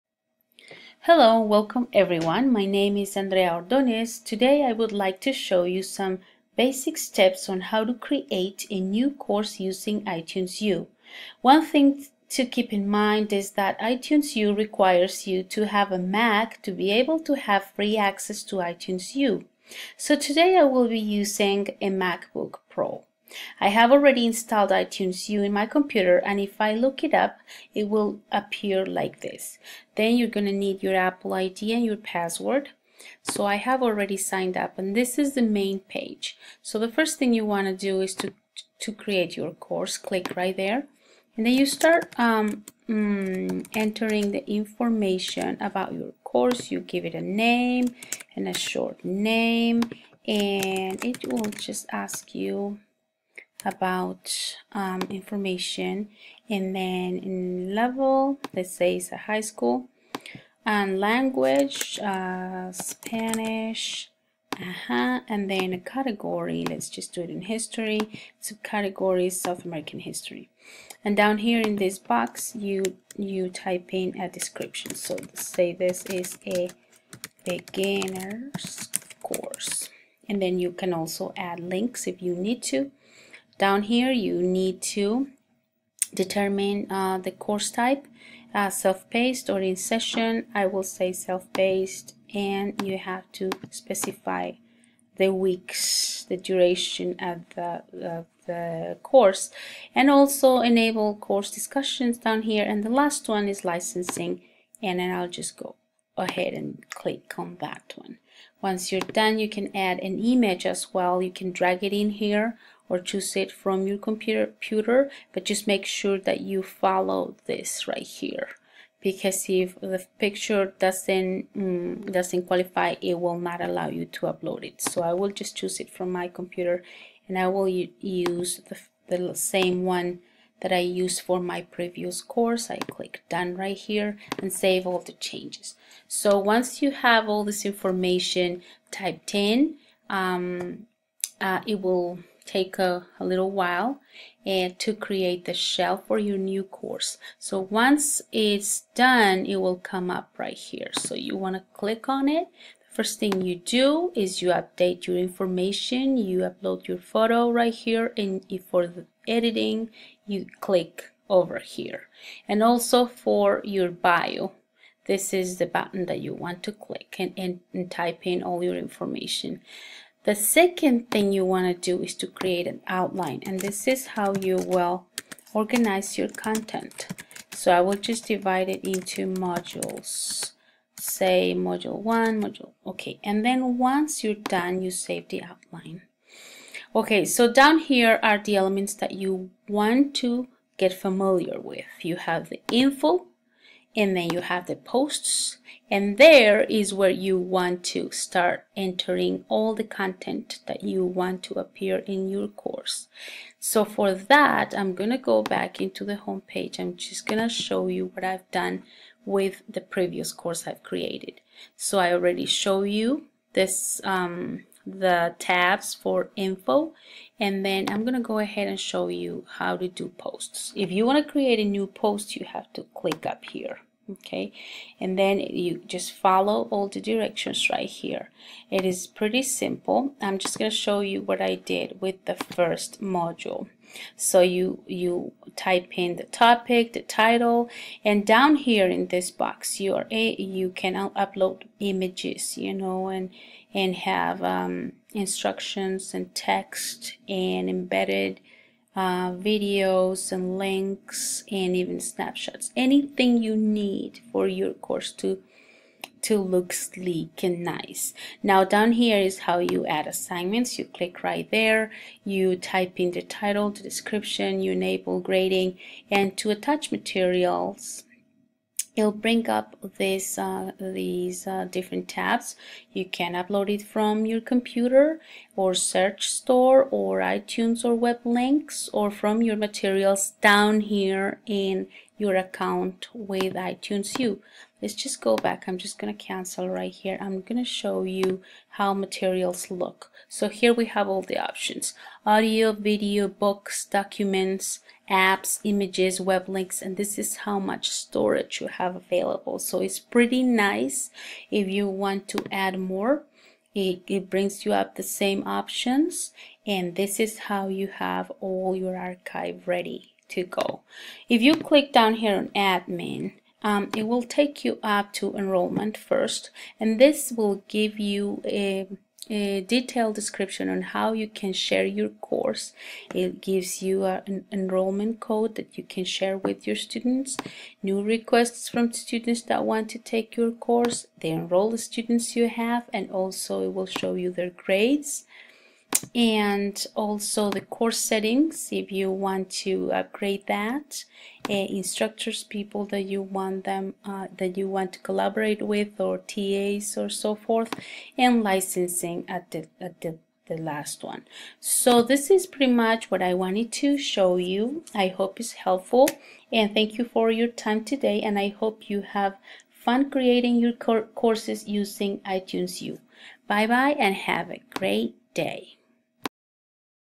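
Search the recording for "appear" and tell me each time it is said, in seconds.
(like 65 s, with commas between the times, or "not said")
28 s, 201 s.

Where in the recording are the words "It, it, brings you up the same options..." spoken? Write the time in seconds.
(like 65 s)
303 s.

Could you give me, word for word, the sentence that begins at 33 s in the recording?
So I have already signed up and this is the main page.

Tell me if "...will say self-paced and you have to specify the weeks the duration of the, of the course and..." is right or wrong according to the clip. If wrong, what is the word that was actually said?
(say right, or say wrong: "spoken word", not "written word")
right.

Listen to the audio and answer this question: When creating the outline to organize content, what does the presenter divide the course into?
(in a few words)
modules.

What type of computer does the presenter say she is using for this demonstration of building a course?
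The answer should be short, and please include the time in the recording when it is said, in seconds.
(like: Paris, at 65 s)
MacBook Pro, at 21 s.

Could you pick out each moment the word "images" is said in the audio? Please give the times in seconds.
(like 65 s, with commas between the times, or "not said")
110 s, 241 s, 295 s.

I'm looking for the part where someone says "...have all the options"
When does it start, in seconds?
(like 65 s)
290 s.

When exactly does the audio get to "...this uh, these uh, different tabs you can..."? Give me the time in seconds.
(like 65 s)
269 s.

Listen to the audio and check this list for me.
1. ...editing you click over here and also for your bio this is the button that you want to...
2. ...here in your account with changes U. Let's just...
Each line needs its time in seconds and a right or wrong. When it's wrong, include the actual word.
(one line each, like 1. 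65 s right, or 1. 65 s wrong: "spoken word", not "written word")
1. 159 s right
2. 280 s wrong: "iTunes", not "changes".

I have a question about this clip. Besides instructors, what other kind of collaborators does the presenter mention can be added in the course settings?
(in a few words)
TAs.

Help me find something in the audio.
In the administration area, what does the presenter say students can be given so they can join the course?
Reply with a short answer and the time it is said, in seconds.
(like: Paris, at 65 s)
enrollment code, at 324 s.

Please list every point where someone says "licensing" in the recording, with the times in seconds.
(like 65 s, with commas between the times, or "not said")
103 s, 348 s.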